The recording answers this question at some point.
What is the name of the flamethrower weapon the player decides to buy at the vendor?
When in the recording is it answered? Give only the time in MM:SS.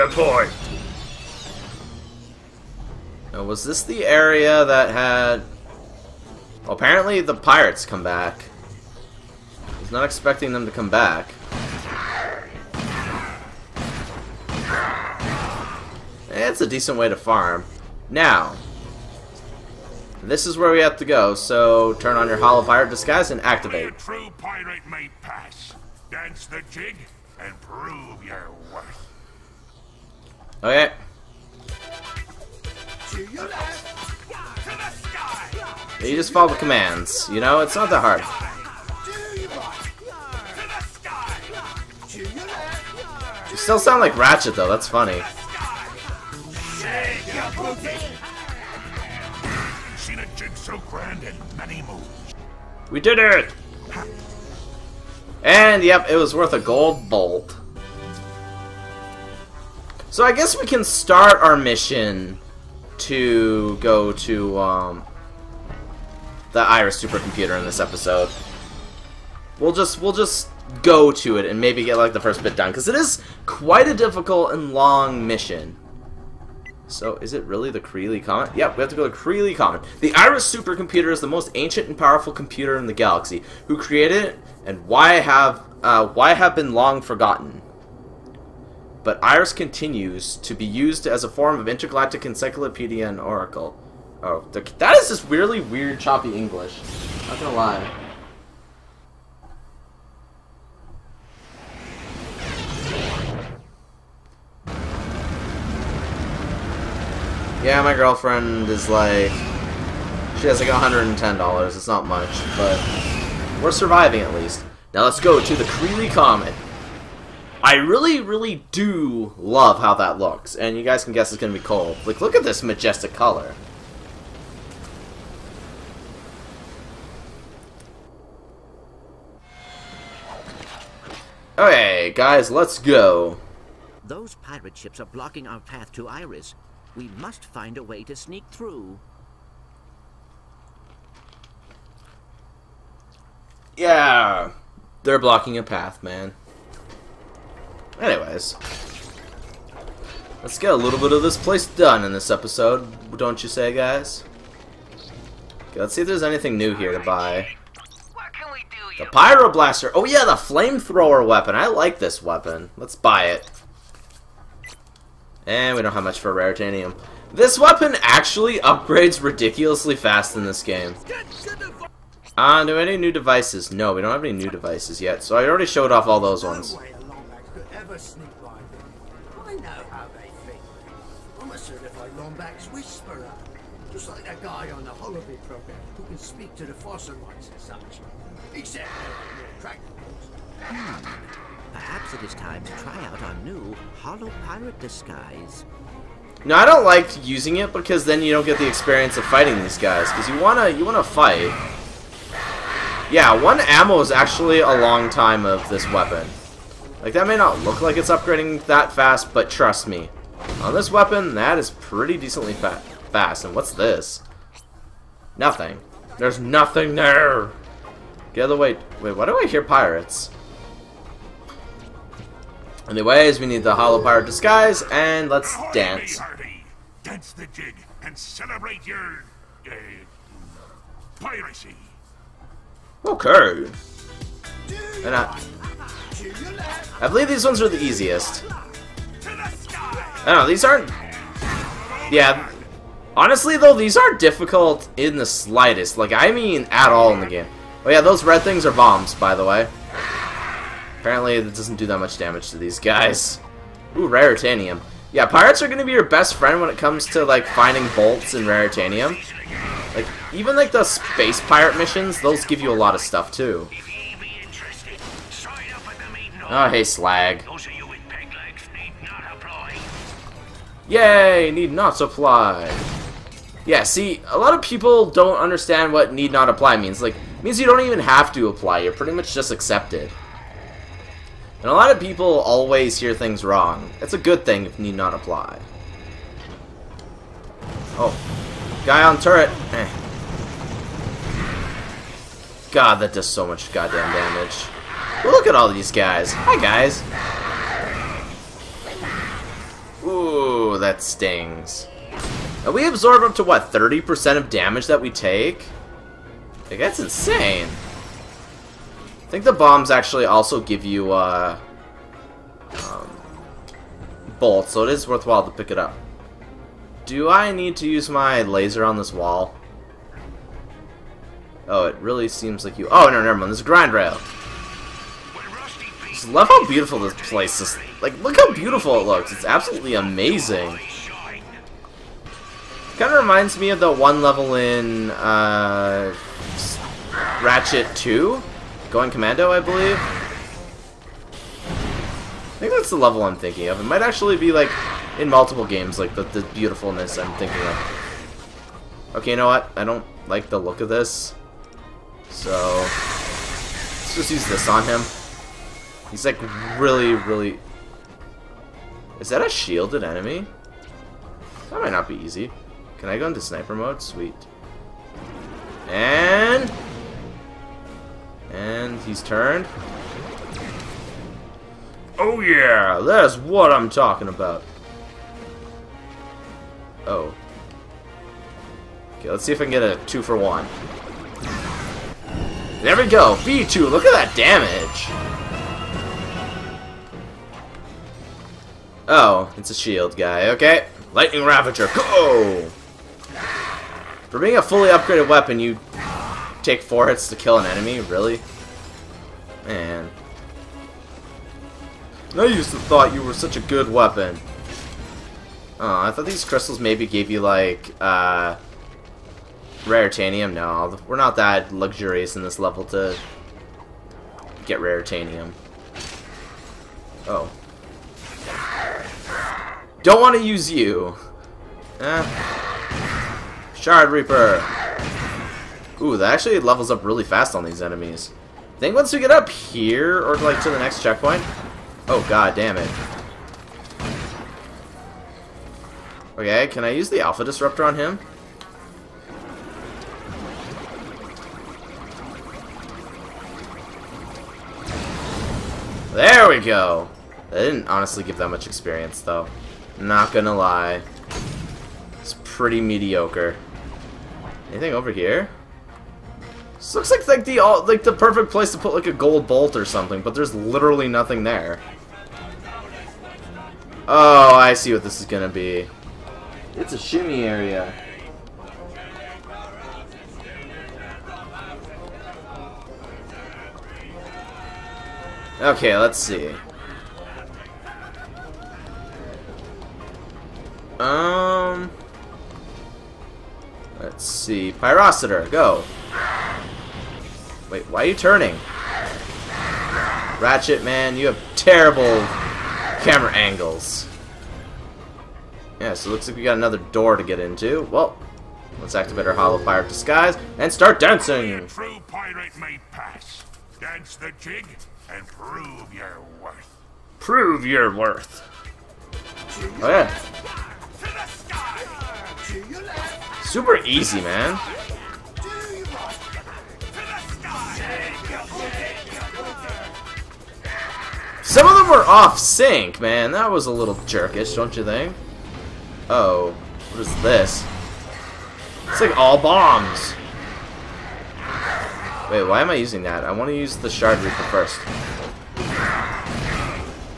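02:38.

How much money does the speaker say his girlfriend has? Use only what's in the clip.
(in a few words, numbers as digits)
$110.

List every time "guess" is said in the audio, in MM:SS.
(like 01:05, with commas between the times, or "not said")
01:00, 02:01.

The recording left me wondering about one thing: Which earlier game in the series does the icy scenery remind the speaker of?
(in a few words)
Going Commando.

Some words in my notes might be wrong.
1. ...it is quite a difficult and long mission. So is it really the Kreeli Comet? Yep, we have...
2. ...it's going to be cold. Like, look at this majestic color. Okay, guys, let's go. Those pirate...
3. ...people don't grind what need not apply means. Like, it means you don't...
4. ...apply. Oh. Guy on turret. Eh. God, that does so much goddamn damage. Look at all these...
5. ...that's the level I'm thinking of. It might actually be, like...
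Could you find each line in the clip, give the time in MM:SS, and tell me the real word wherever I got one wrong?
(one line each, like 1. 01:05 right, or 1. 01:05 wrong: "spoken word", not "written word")
1. 01:12 right
2. 02:01 right
3. 04:34 wrong: "understand", not "grind"
4. 04:45 right
5. 05:42 right.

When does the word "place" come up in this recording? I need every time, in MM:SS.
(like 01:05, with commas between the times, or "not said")
02:31, 05:27, 07:38.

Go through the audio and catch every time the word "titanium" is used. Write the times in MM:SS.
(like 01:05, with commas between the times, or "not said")
02:46, 06:50, 06:55.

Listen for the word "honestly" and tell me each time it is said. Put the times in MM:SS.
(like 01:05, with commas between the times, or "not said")
04:03, 07:27.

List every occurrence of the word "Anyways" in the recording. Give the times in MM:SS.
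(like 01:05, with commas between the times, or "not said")
02:28, 03:42.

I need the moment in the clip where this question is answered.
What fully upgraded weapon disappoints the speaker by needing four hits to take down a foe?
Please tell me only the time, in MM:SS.
06:31.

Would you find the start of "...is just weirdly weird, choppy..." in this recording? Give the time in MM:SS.
01:34.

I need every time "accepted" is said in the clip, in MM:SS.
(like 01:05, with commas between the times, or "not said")
04:39.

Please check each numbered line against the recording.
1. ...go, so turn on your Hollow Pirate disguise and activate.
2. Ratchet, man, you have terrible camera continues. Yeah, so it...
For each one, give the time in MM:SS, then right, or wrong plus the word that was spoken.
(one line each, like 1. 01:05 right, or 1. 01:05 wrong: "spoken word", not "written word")
1. 00:21 right
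2. 08:10 wrong: "angles", not "continues".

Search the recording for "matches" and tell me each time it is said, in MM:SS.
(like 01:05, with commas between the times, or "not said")
not said.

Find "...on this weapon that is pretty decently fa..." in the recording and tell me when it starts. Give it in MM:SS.
03:30.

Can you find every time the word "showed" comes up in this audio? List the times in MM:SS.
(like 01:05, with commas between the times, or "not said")
02:55.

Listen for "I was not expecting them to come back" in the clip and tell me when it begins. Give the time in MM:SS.
00:09.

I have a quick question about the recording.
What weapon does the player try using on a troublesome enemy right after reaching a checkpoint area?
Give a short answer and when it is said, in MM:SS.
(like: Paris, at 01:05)
Alpha Disruptor, at 07:17.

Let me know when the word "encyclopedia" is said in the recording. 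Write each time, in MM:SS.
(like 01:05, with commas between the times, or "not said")
01:32.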